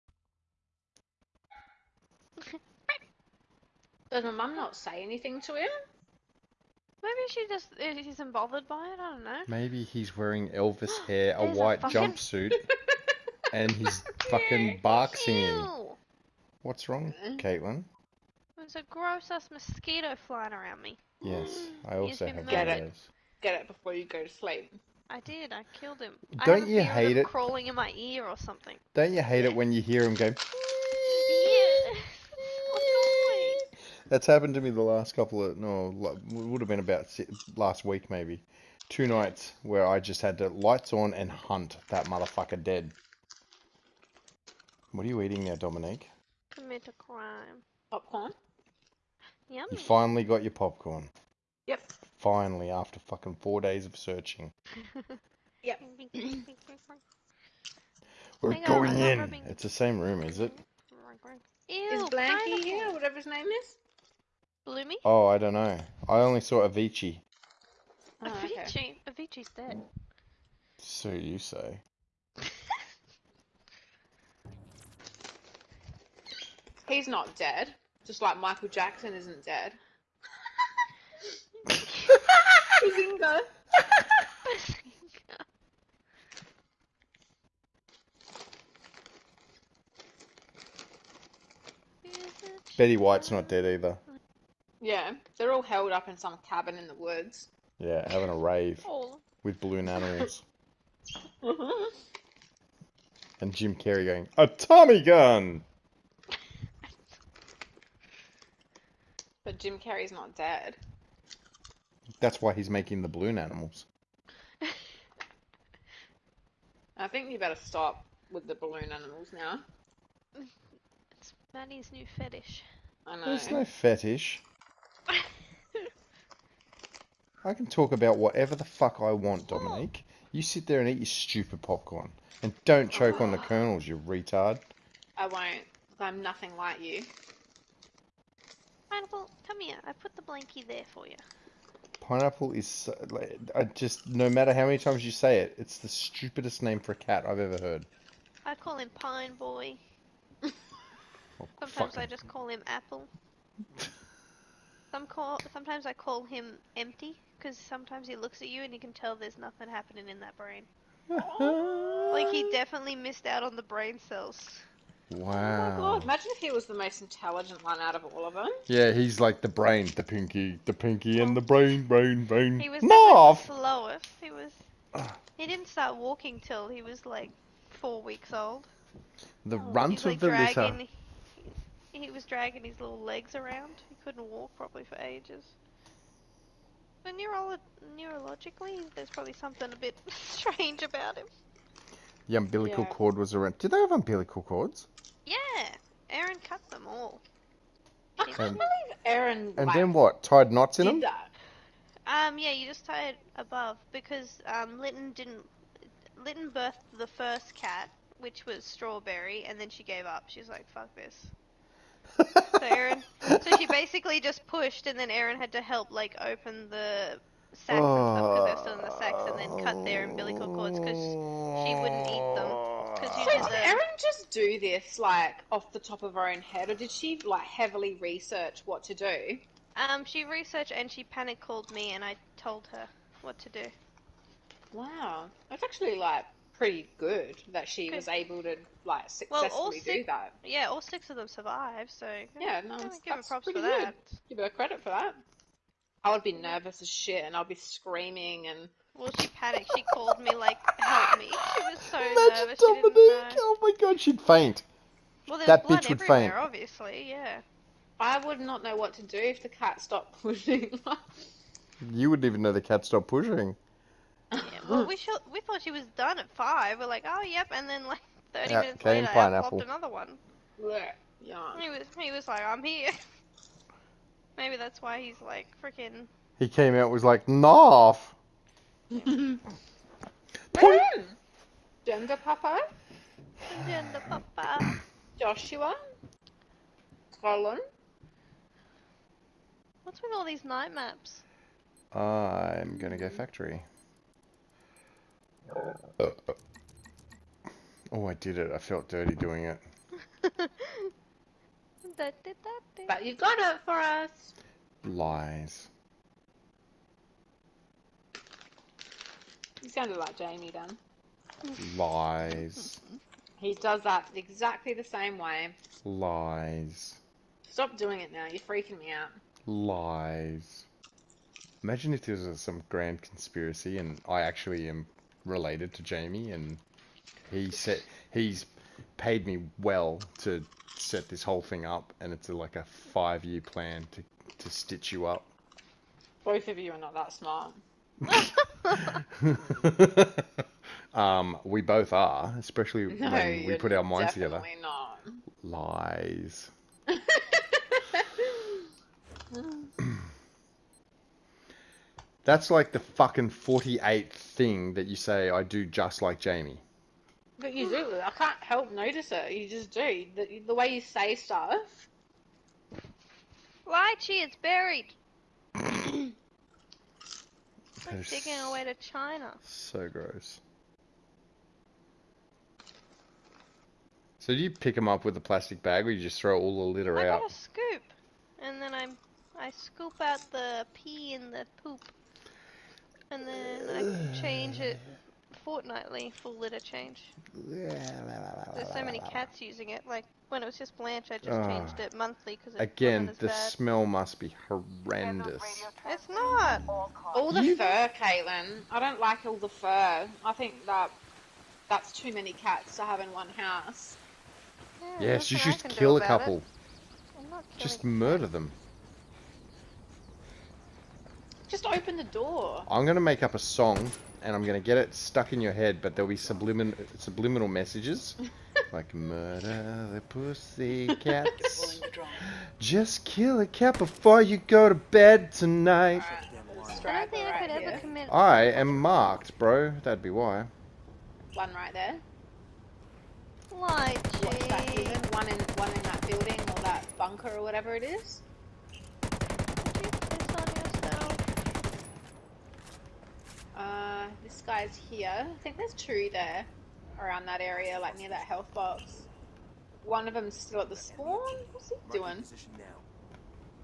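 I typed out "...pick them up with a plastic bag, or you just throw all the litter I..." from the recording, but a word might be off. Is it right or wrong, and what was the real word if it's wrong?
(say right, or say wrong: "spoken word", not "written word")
right.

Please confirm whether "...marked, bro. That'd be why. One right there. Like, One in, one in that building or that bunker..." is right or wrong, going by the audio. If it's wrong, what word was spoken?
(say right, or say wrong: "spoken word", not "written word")
right.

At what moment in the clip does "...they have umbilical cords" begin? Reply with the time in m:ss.
3:13.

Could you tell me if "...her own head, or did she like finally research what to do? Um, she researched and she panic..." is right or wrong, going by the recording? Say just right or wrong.
wrong.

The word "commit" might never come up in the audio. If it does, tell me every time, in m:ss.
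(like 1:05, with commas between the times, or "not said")
0:46, 7:07.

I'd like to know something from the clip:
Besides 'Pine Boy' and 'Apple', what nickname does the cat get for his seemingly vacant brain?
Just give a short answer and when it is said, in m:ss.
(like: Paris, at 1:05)
Empty, at 2:36.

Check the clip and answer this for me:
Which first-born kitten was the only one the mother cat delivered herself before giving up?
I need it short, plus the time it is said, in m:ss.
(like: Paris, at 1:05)
Strawberry, at 3:28.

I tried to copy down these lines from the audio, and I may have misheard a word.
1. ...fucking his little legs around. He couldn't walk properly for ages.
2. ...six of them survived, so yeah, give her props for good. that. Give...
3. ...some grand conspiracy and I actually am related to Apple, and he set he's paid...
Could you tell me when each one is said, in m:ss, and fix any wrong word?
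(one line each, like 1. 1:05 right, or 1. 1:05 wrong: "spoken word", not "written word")
1. 3:02 wrong: "dragging", not "fucking"
2. 4:00 right
3. 5:22 wrong: "Jamie", not "Apple".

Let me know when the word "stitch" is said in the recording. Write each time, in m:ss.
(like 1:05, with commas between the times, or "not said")
5:34.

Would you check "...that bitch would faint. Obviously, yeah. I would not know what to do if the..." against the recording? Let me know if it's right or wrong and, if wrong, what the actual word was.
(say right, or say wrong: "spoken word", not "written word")
right.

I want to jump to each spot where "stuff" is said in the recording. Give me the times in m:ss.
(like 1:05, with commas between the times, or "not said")
3:38, 6:01.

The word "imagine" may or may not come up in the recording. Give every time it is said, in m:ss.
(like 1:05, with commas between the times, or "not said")
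2:46, 4:11, 5:21.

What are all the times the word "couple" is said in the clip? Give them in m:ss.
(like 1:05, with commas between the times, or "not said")
0:35, 6:45.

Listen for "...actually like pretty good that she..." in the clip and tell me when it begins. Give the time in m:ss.
3:55.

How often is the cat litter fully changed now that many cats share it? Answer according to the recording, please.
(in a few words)
Fortnightly.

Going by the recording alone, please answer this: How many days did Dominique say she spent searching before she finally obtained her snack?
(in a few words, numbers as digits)
4.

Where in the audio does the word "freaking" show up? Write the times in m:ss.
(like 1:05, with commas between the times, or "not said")
4:35, 5:18.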